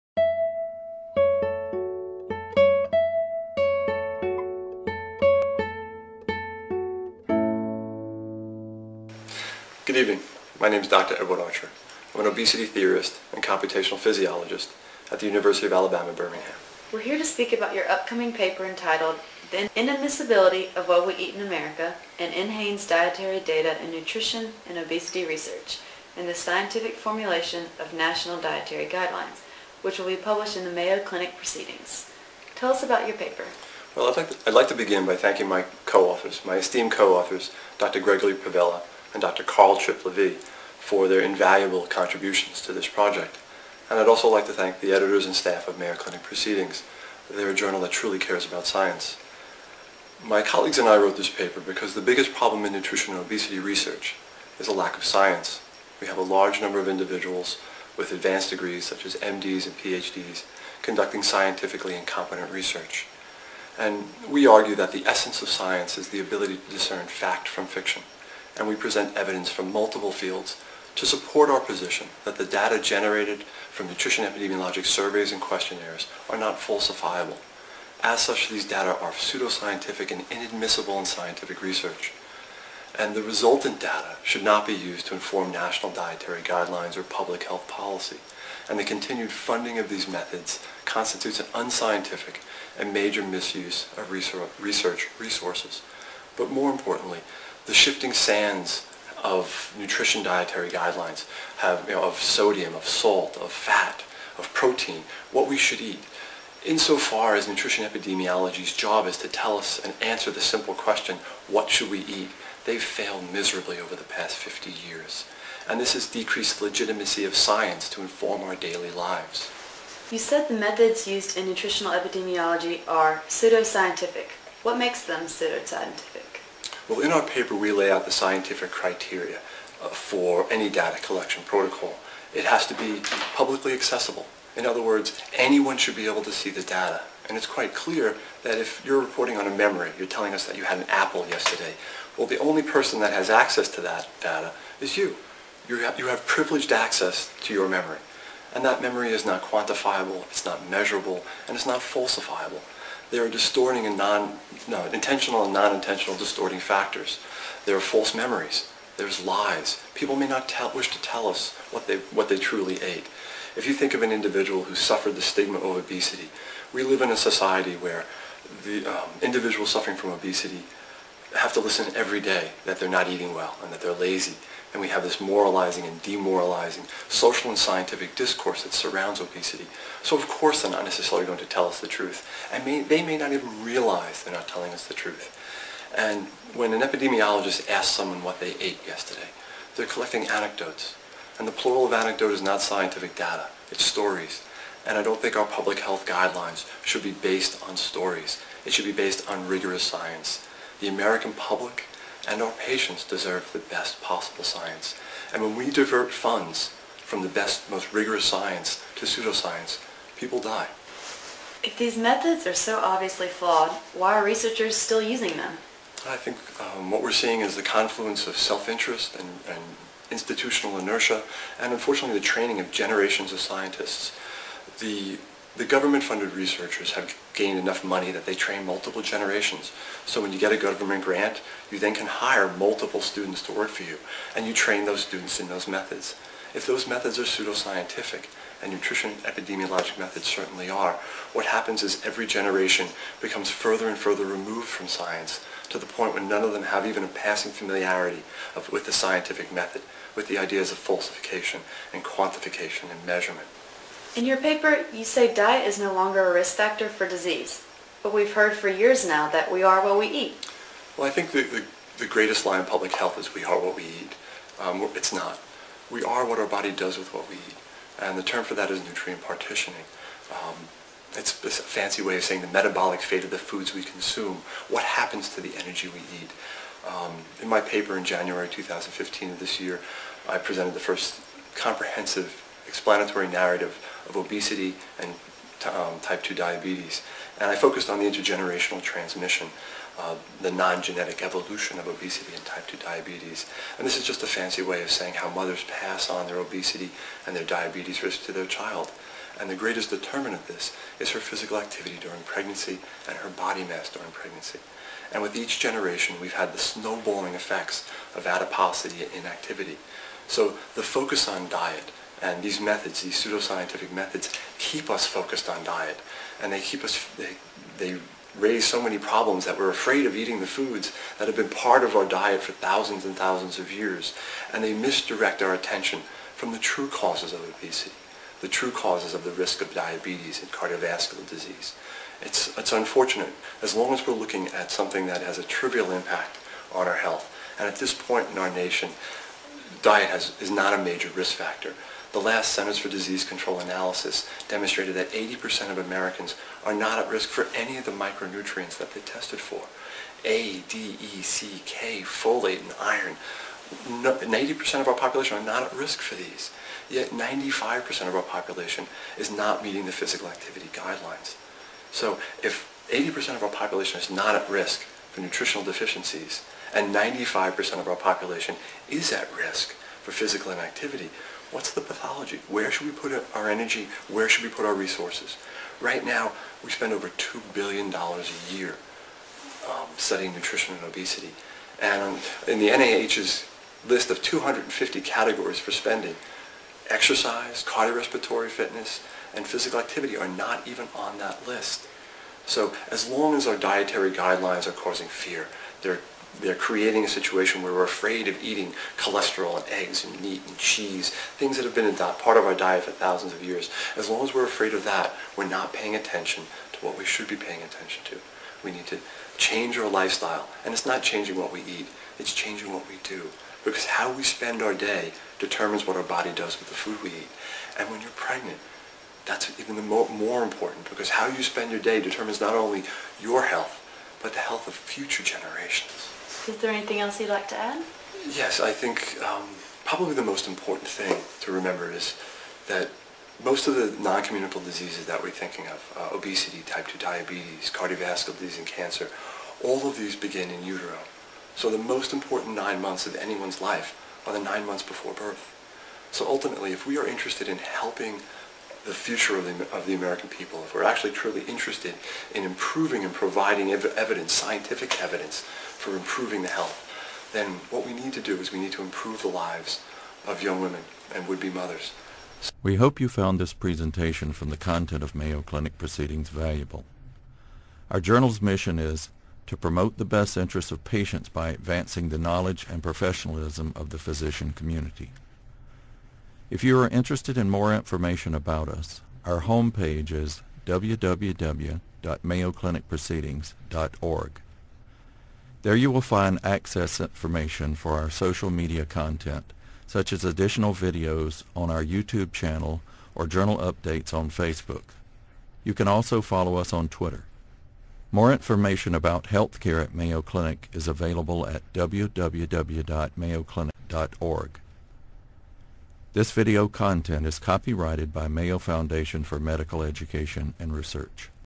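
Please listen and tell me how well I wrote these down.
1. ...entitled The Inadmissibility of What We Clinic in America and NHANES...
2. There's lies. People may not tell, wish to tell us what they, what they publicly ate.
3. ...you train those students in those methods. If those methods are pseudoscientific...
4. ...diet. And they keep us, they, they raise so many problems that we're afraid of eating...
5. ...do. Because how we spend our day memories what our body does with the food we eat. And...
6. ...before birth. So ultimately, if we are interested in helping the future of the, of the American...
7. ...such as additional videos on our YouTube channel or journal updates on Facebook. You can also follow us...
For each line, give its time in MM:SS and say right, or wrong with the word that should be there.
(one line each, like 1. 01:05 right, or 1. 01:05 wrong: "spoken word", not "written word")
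1. 00:18 wrong: "Eat", not "Clinic"
2. 02:38 wrong: "truly", not "publicly"
3. 03:54 right
4. 05:15 right
5. 06:53 wrong: "determines", not "memories"
6. 07:24 right
7. 08:09 right.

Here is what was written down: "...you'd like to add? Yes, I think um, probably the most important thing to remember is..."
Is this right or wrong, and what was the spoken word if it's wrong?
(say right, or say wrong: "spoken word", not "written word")
right.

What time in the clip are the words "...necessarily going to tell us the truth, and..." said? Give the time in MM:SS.
03:00.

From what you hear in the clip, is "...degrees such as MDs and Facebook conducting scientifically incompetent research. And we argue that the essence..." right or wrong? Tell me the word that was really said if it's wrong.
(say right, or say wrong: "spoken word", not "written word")
wrong: "PhDs", not "Facebook".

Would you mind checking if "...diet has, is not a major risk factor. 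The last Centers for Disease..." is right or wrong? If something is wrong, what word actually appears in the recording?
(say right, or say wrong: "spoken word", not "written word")
right.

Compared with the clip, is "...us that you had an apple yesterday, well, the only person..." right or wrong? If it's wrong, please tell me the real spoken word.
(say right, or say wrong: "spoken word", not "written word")
right.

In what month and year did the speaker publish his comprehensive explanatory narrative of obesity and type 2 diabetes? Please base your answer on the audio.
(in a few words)
January 2015.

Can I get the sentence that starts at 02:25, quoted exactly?
You have, you have privileged access to your memory.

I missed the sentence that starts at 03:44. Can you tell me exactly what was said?
The the government-funded researchers have gained enough money that they train multiple generations.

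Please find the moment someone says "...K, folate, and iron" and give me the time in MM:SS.
05:51.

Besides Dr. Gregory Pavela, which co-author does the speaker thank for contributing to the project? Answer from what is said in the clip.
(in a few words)
Carl Tripp.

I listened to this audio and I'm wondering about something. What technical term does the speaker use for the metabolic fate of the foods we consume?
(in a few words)
nutrient partitioning.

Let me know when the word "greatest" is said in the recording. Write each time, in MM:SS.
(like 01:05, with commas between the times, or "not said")
04:22, 04:59.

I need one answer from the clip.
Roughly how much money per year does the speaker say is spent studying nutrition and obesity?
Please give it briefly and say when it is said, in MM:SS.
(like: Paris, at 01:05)
over $2 billion, at 06:16.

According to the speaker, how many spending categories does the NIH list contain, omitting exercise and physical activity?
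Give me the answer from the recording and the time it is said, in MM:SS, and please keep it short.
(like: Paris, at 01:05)
250, at 06:24.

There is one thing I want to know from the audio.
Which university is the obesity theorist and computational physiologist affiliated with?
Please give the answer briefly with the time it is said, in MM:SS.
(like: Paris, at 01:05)
University of Alabama, Birmingham, at 00:15.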